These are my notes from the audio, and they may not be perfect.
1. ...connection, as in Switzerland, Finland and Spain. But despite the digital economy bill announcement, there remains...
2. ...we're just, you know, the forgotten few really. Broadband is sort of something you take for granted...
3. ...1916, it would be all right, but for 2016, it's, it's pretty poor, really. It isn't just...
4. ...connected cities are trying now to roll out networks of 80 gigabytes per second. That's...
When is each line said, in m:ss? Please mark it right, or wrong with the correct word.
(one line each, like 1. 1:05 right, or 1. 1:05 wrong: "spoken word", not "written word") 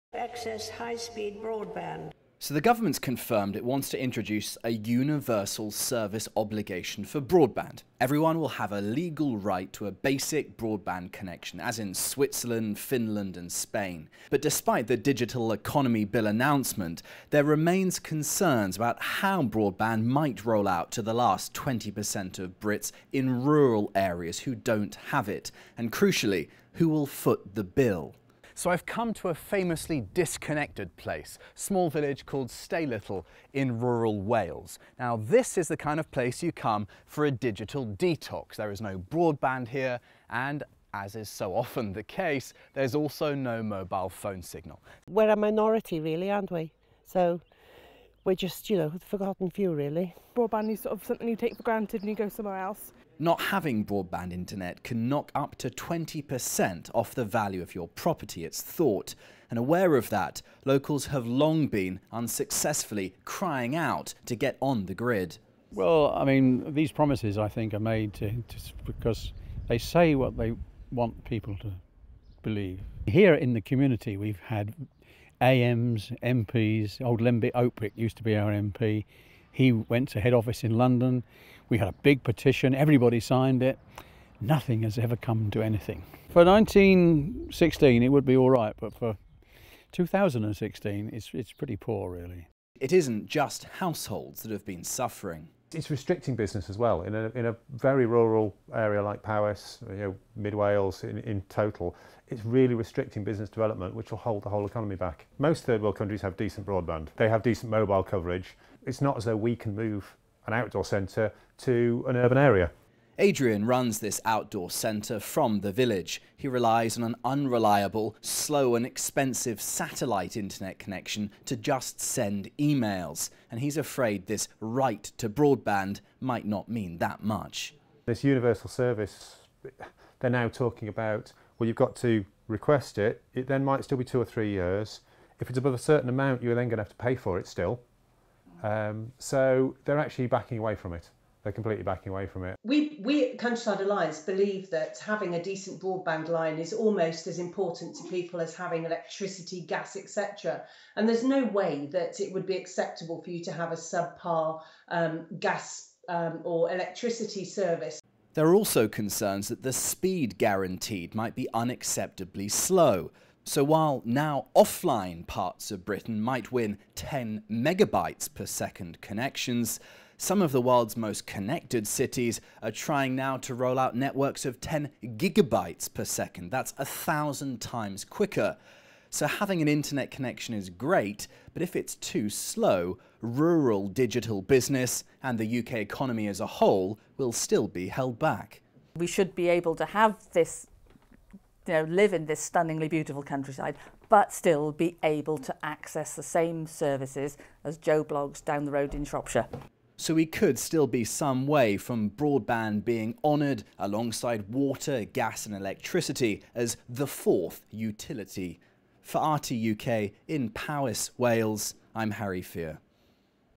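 1. 0:11 right
2. 0:48 right
3. 1:26 right
4. 2:51 wrong: "10", not "80".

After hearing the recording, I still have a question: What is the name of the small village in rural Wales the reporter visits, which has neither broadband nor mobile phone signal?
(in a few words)
Staylittle.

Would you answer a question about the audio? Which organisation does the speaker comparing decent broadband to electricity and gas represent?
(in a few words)
Countryside Alliance.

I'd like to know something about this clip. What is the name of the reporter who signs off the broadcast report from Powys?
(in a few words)
Harry Fear.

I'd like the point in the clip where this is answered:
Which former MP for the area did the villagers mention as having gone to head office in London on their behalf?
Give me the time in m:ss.
1:17.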